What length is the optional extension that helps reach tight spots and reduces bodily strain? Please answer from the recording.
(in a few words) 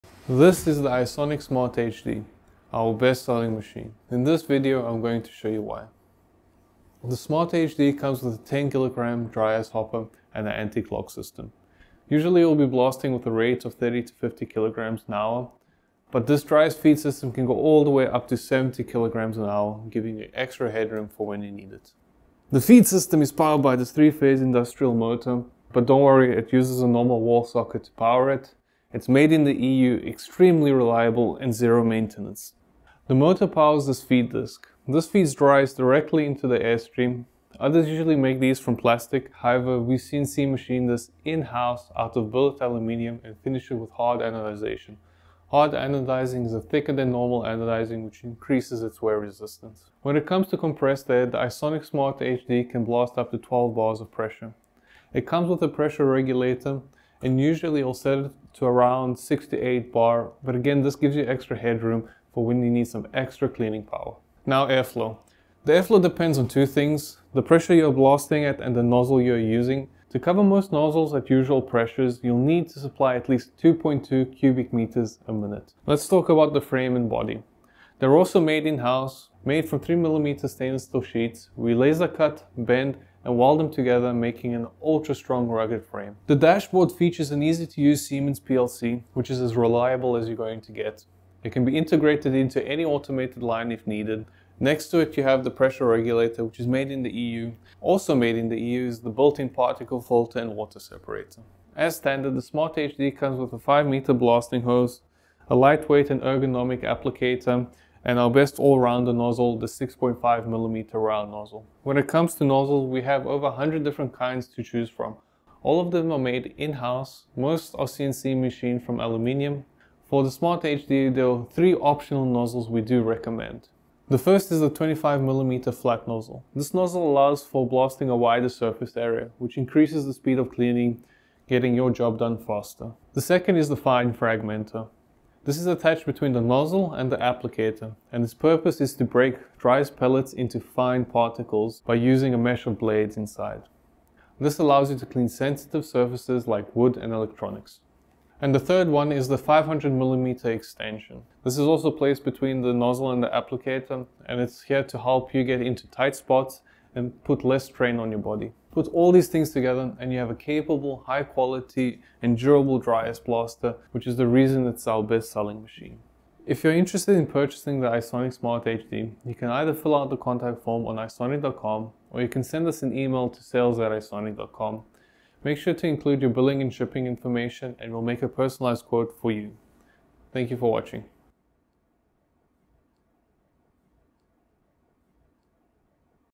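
500mm.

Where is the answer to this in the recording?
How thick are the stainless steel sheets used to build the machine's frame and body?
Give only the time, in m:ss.
1:19.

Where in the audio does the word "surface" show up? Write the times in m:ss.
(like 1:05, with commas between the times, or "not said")
2:08, 2:25.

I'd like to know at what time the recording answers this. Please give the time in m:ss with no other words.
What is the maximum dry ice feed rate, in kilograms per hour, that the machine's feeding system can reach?
0:18.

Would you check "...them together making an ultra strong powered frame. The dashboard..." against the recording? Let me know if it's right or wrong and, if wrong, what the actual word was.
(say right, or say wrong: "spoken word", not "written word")
wrong: "rugged", not "powered".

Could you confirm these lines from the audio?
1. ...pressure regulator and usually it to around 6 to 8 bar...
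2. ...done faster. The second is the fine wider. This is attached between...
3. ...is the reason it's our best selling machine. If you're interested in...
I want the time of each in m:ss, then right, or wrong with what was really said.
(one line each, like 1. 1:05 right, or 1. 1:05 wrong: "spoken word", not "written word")
1. 0:55 right
2. 2:12 wrong: "fragmenter", not "wider"
3. 2:44 right.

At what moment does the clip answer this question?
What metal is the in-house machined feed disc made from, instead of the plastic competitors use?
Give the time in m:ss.
0:42.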